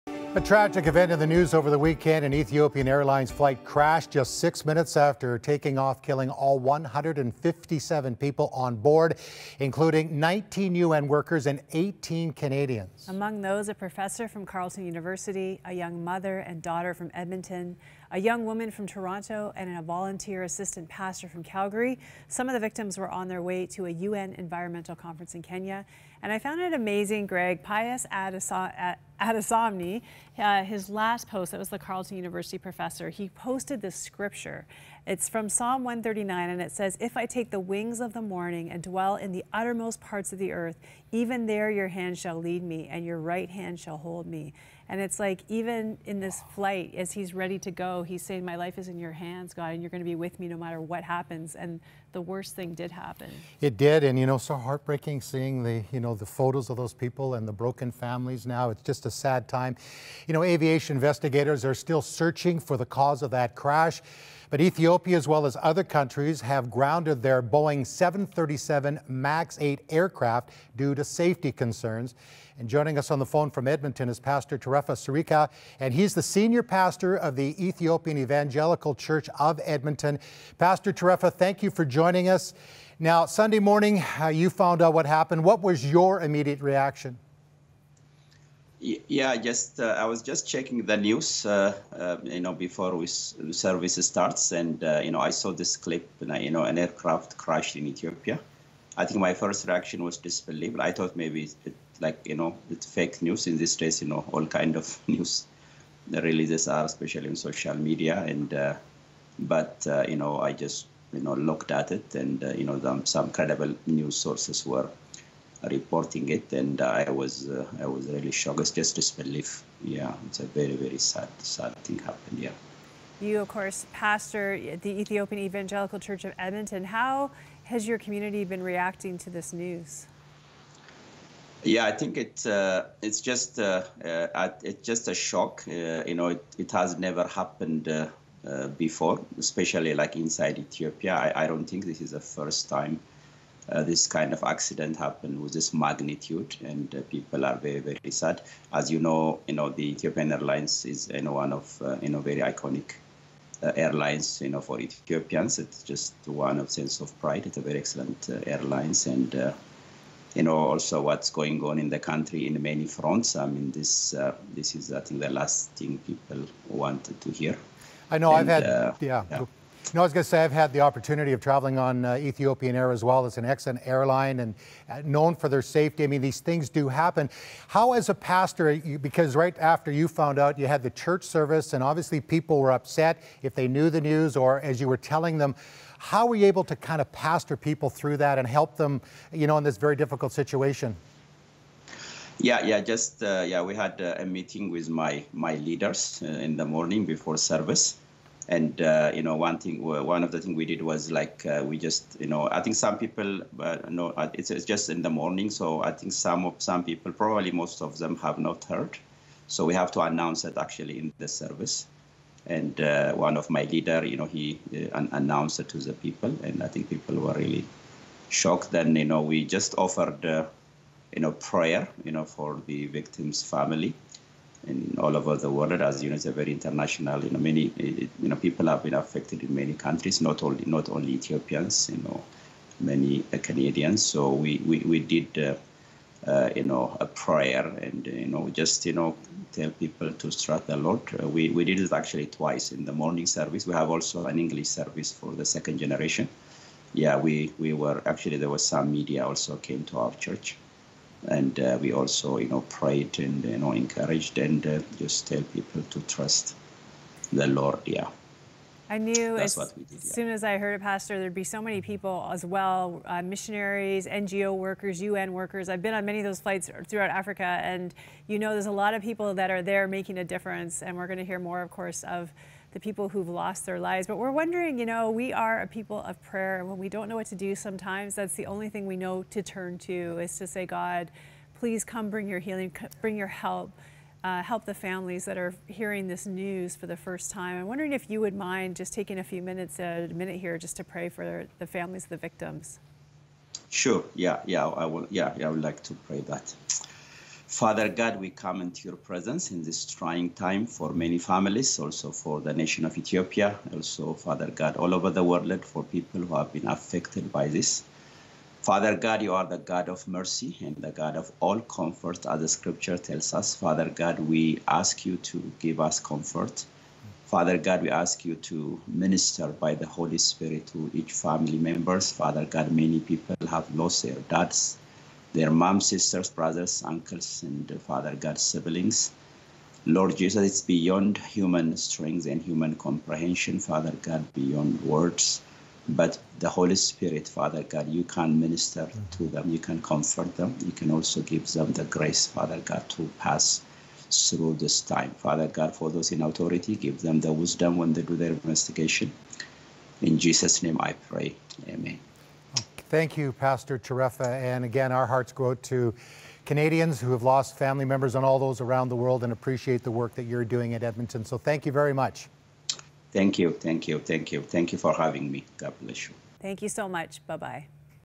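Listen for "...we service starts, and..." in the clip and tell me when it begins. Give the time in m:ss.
1:32.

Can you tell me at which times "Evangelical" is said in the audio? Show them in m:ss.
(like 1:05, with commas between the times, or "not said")
1:18, 2:05.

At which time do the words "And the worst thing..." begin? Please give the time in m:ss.
0:51.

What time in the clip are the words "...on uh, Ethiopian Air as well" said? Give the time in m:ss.
2:51.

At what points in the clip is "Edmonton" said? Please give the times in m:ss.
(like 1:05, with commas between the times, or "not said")
0:17, 1:13, 1:19, 2:06, 6:00.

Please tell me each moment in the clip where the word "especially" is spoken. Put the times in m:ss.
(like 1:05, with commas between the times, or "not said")
1:46, 2:19.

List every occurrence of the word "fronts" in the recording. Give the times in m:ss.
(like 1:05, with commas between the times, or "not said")
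2:42.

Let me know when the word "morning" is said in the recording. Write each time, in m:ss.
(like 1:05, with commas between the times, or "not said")
0:38, 1:23, 3:16, 3:25, 4:02.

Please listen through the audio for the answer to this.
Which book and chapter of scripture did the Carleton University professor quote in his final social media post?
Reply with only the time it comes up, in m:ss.
0:35.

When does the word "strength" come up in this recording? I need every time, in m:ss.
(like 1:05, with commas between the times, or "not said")
5:31.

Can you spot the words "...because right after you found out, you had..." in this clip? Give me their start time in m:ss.
2:58.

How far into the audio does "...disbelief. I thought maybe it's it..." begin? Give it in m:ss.
1:40.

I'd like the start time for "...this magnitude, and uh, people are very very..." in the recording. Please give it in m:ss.
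2:25.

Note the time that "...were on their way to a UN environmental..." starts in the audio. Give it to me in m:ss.
0:22.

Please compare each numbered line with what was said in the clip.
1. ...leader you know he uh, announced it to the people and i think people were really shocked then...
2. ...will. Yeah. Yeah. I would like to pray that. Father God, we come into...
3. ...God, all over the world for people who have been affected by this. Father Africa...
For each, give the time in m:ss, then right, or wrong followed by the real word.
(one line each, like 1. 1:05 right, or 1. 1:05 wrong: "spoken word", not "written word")
1. 3:33 right
2. 4:54 right
3. 5:04 wrong: "God", not "Africa".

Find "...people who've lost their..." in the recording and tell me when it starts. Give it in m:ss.
4:32.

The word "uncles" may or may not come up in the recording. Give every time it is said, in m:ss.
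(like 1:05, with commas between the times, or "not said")
5:26.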